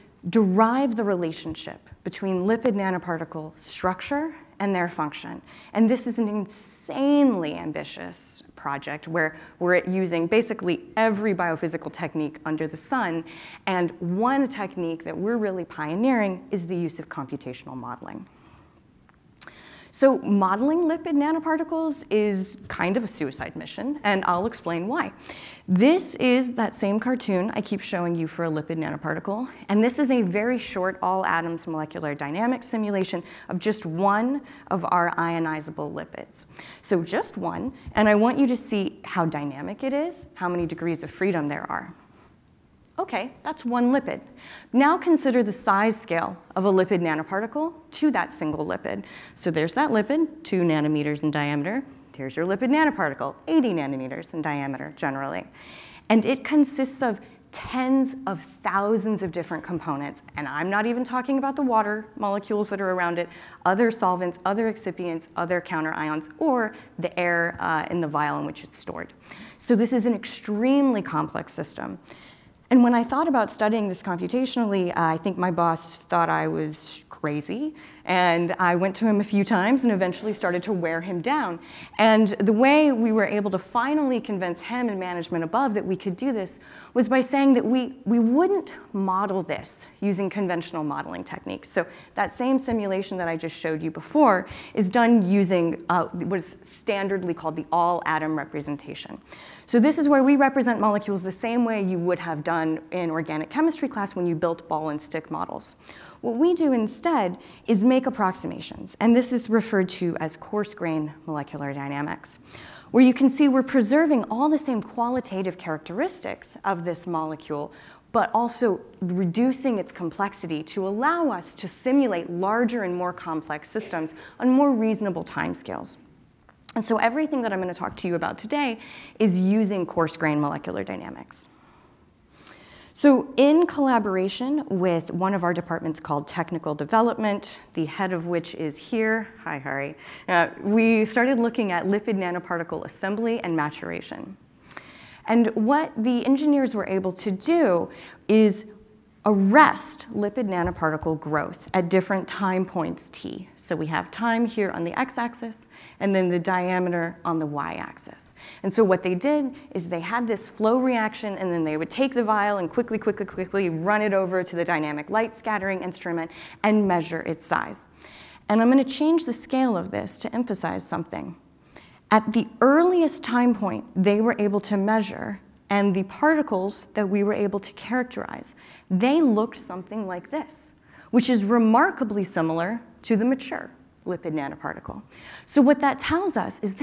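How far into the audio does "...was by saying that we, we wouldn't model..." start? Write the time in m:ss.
1:26.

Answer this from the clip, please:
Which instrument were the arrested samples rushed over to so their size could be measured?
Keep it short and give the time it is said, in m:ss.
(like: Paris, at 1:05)
dynamic light scattering instrument, at 2:44.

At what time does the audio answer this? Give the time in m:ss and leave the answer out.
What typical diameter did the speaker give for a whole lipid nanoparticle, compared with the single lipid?
0:53.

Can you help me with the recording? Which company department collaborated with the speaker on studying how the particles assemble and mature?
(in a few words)
Technical Development.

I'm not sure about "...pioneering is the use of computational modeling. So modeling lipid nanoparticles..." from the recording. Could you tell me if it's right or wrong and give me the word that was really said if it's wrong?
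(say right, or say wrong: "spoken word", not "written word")
right.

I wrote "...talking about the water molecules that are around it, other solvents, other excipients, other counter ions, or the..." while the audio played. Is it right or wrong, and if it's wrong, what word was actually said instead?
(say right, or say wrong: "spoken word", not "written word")
right.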